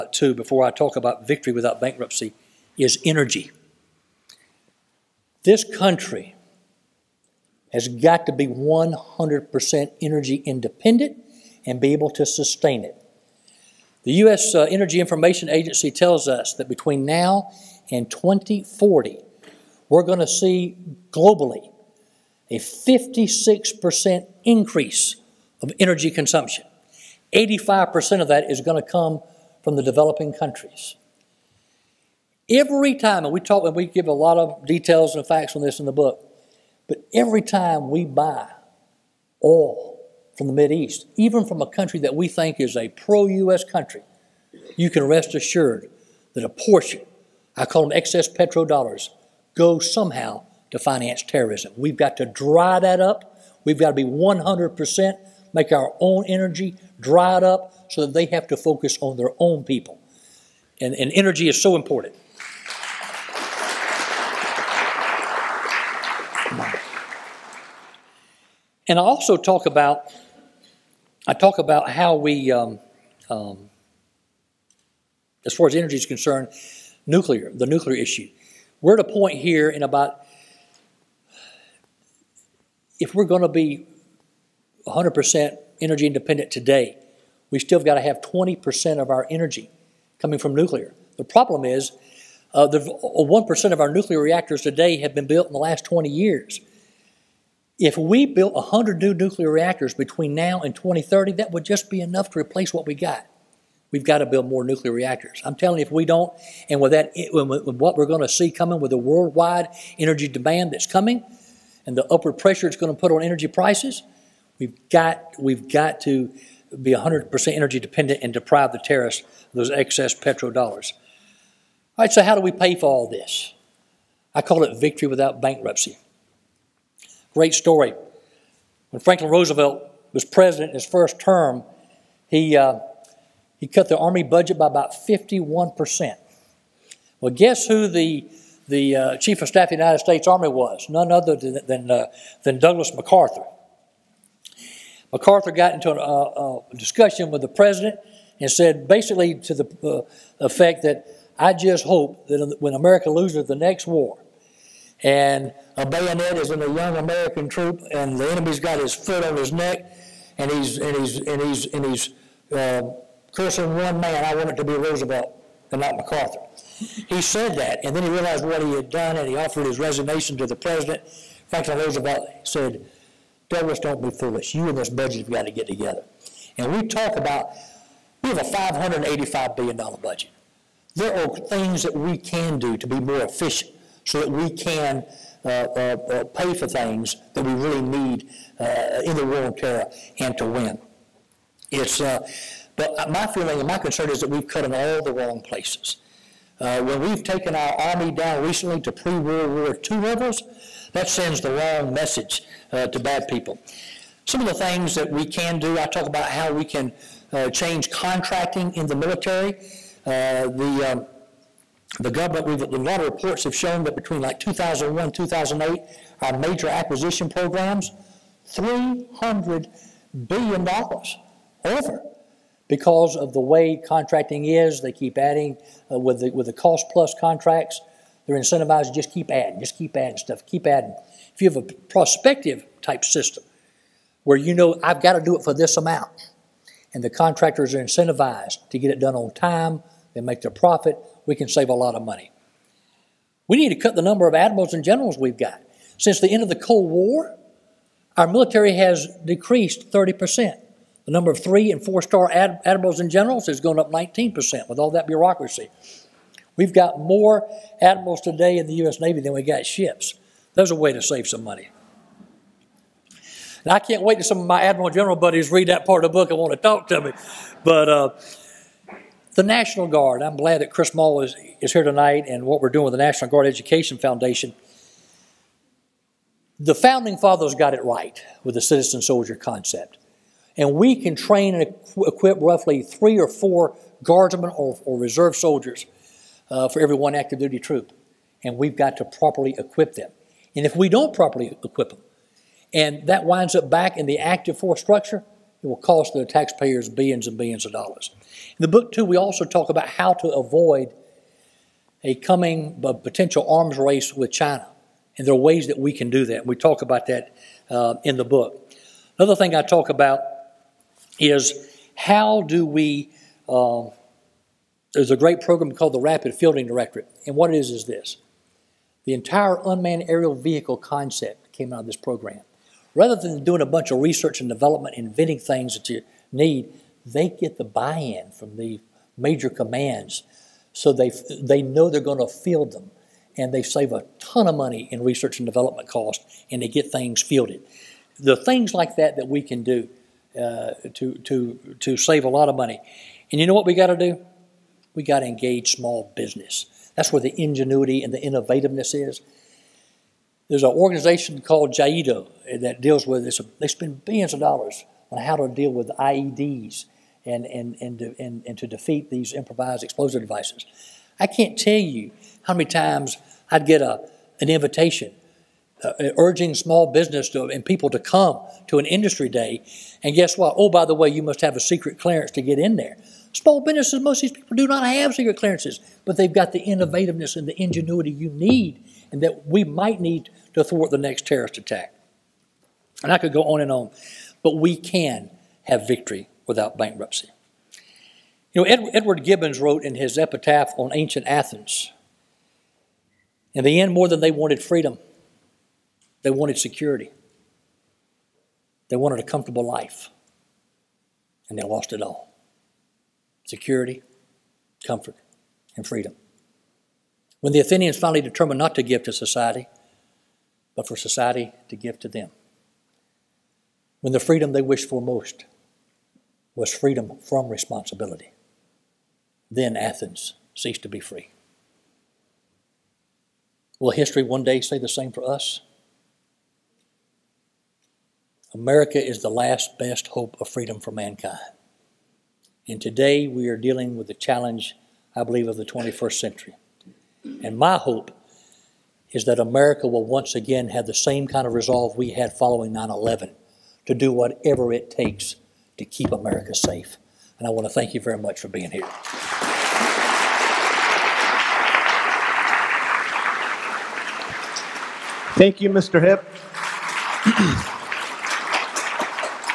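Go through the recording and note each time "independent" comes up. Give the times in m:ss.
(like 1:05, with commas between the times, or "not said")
0:10, 1:26.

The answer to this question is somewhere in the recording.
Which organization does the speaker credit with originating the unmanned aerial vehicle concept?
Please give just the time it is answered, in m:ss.
5:16.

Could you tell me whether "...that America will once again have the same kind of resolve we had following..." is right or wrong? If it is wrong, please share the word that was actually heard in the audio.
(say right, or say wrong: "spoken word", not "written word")
right.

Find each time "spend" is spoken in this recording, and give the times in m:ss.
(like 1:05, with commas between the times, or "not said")
5:53.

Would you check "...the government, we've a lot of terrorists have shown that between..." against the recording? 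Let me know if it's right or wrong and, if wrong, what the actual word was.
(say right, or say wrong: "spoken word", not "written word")
wrong: "reports", not "terrorists".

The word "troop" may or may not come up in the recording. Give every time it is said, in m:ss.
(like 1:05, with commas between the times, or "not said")
2:37, 4:47.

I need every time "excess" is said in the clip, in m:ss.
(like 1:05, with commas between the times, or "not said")
0:47, 1:59.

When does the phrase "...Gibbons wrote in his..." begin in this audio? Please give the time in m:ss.
6:29.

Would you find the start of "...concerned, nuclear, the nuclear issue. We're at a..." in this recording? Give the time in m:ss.
1:16.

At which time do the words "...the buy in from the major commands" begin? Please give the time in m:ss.
5:27.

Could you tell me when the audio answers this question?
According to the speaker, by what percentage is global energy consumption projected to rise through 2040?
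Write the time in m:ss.
0:22.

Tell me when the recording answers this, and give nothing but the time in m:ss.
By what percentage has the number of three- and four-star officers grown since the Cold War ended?
4:13.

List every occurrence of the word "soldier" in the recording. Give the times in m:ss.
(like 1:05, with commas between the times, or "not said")
4:39, 4:45.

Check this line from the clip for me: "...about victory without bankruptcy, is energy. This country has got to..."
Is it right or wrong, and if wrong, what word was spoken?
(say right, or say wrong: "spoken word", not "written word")
right.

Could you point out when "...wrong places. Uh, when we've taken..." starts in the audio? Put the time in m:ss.
3:15.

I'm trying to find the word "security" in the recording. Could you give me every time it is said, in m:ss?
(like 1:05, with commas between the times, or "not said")
6:36, 6:43.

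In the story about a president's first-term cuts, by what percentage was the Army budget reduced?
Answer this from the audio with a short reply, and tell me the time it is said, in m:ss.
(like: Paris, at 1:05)
51%, at 2:14.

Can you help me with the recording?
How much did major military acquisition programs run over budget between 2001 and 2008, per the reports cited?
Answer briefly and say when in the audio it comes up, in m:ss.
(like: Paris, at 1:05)
300 billion dollars, at 3:38.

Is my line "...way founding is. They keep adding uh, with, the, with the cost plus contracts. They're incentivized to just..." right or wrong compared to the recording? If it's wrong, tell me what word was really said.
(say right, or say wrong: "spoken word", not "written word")
wrong: "contracting", not "founding".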